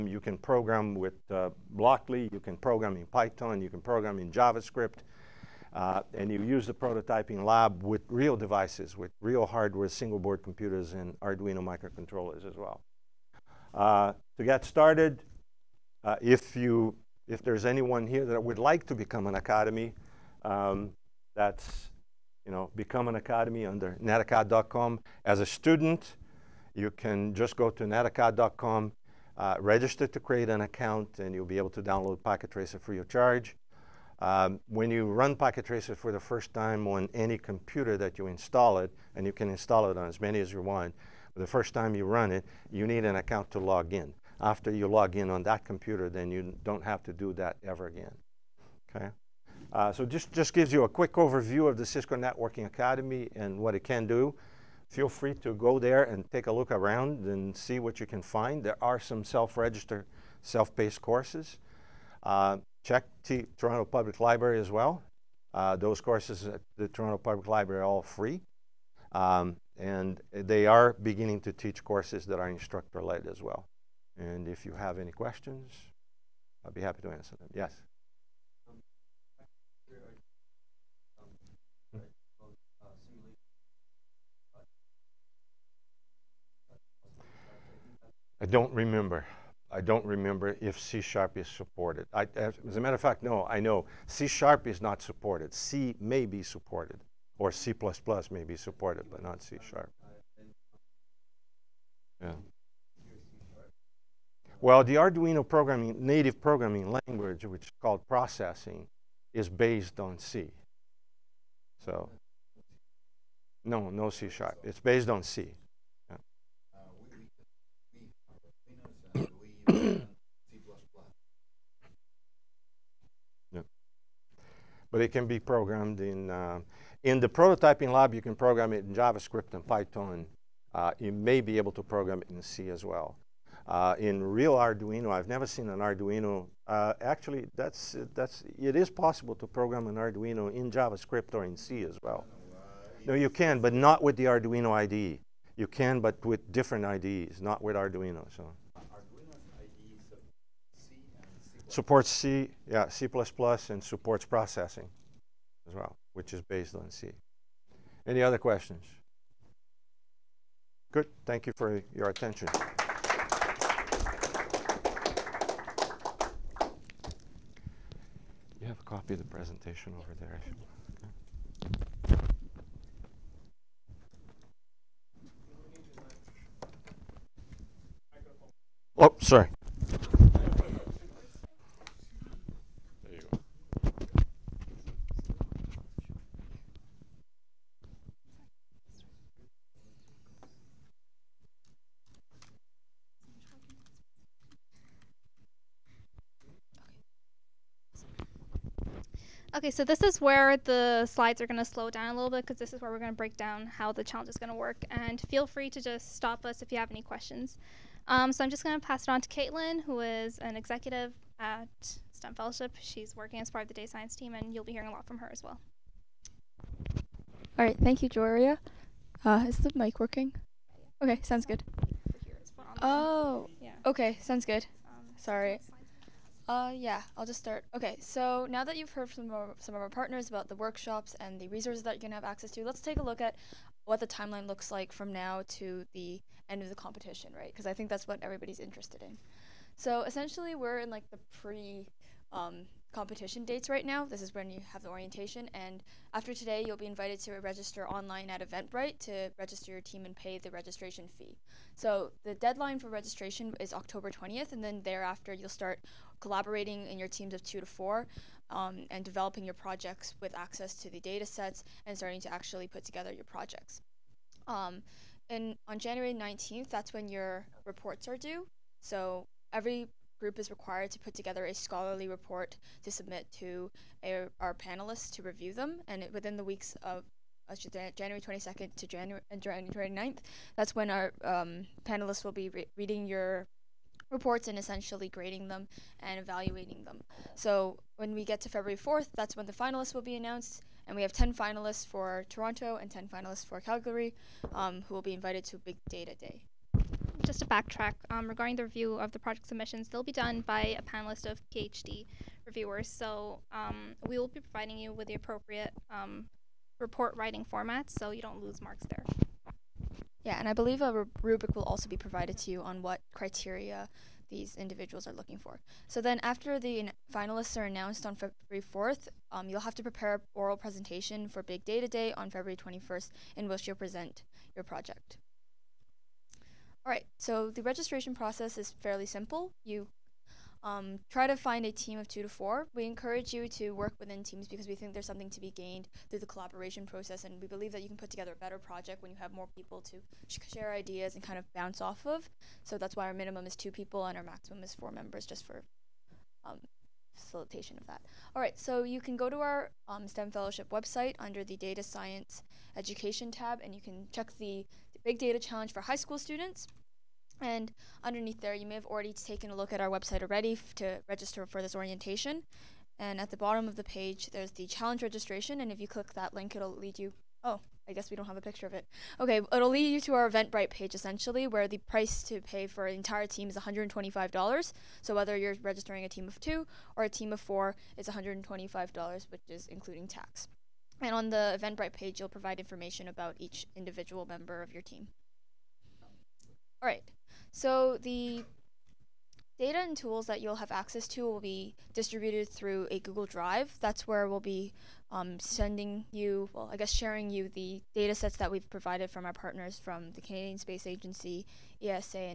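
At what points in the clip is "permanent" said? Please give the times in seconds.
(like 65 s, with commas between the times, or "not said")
not said.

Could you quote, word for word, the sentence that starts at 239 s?
So essentially, we're in like the pre um, competition dates right now.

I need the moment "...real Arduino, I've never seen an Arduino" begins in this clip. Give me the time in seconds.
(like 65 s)
134 s.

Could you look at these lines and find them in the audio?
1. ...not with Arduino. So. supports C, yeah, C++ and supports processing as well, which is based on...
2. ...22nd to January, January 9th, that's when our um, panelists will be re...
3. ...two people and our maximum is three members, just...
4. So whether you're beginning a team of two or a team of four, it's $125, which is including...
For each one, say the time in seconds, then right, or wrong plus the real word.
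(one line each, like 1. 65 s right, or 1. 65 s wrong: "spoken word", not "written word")
1. 147 s right
2. 278 s right
3. 343 s wrong: "four", not "three"
4. 375 s wrong: "registering", not "beginning".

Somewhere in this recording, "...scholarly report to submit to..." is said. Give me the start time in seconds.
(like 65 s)
271 s.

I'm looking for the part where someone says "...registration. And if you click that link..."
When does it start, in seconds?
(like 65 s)
365 s.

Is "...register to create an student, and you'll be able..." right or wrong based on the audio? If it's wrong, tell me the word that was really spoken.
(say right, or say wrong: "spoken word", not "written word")
wrong: "account", not "student".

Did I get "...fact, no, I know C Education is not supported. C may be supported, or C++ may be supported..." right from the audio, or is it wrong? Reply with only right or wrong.
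wrong.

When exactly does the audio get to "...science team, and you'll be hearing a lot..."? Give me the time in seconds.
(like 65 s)
213 s.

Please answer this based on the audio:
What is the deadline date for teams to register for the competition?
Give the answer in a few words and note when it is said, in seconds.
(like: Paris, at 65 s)
October 20th, at 253 s.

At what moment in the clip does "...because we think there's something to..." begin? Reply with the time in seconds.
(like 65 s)
334 s.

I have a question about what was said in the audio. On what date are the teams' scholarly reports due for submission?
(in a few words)
January 19th.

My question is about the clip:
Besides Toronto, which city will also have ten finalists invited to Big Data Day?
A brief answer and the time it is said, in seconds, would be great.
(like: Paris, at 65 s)
Calgary, at 293 s.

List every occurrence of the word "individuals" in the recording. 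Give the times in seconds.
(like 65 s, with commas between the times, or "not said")
314 s, 383 s.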